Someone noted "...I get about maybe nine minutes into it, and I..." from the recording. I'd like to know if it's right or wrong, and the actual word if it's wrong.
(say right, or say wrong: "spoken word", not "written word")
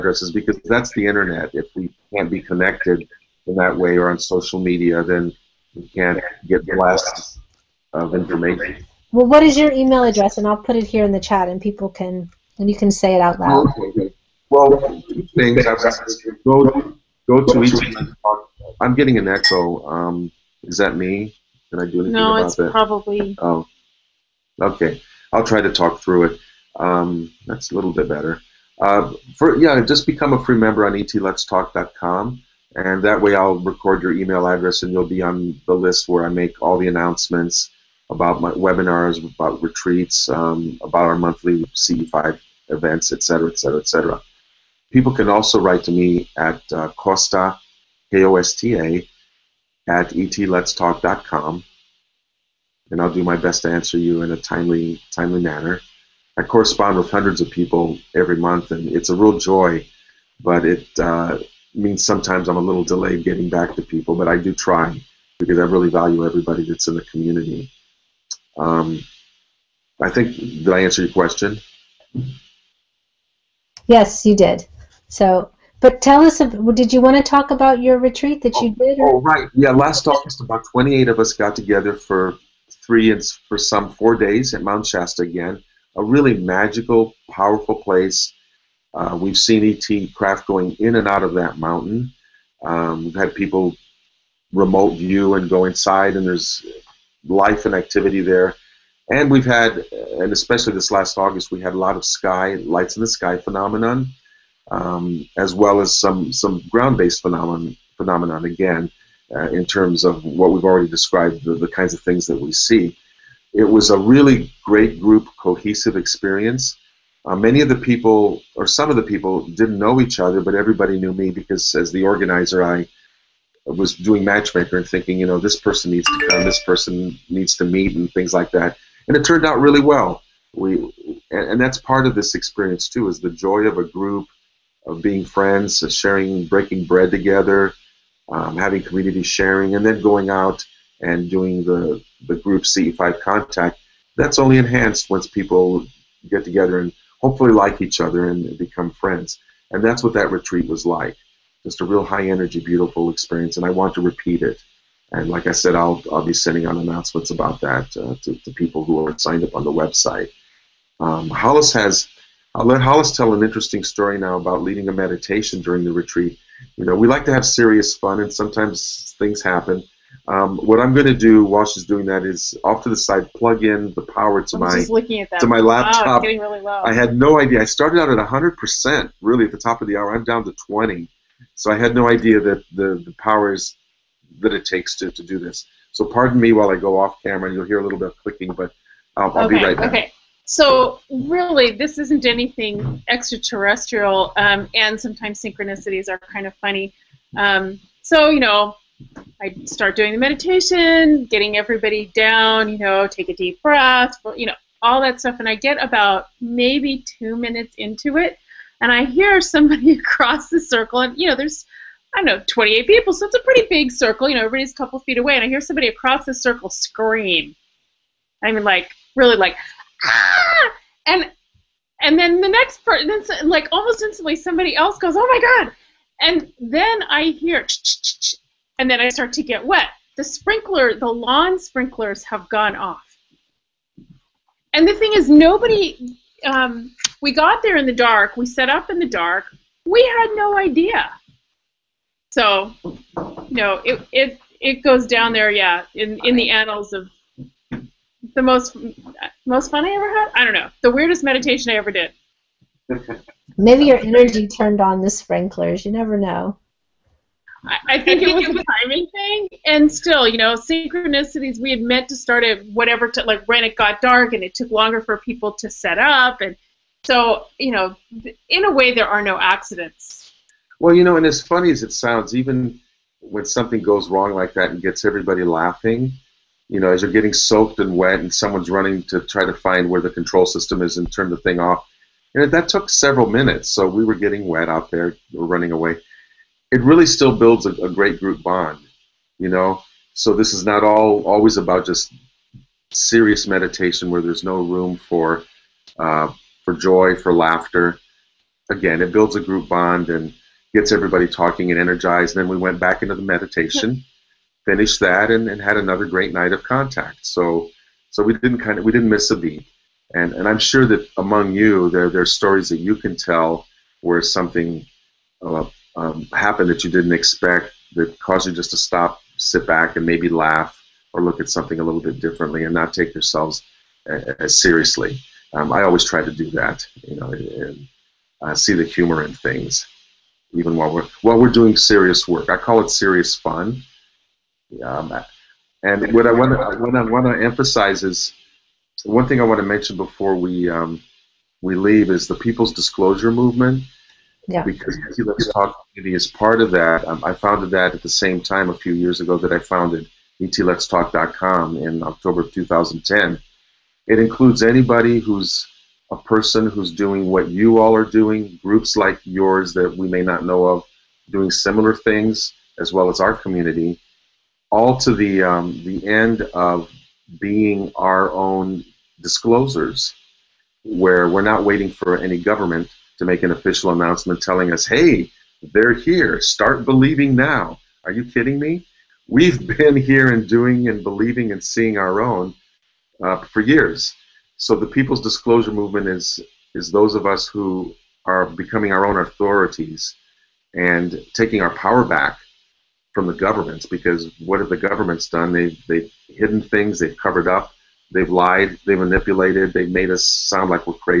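wrong: "two", not "nine".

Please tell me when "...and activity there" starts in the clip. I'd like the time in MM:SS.
01:37.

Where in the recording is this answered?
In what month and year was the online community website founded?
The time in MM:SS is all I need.
05:52.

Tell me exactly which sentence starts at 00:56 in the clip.
I correspond with hundreds of people every month, and it's a real joy.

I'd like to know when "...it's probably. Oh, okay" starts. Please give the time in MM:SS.
00:22.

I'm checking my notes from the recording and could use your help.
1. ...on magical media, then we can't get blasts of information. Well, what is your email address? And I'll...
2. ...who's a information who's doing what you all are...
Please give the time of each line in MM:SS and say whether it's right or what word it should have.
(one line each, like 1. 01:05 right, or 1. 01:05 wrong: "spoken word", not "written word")
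1. 00:04 wrong: "social", not "magical"
2. 05:55 wrong: "person", not "information".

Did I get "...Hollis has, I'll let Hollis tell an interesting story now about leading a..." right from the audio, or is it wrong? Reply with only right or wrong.
right.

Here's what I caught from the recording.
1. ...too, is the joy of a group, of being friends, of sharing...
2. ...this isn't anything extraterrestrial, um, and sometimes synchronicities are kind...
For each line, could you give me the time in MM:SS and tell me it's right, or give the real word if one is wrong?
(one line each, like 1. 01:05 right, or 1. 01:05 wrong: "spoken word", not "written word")
1. 02:12 right
2. 03:11 right.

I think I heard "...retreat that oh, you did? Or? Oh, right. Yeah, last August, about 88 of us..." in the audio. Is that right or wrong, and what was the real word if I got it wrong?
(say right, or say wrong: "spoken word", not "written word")
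wrong: "28", not "88".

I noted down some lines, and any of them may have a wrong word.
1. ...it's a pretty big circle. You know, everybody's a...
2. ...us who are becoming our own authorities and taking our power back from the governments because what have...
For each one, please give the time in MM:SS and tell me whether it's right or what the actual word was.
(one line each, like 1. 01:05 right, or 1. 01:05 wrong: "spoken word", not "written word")
1. 03:33 right
2. 06:27 right.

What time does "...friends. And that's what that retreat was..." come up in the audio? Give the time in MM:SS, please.
02:28.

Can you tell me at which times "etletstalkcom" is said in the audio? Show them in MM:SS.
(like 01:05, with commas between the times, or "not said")
00:30, 00:50, 05:50.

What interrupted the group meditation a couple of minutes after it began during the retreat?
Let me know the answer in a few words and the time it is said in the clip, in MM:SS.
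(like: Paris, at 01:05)
Lawn sprinklers, at 03:51.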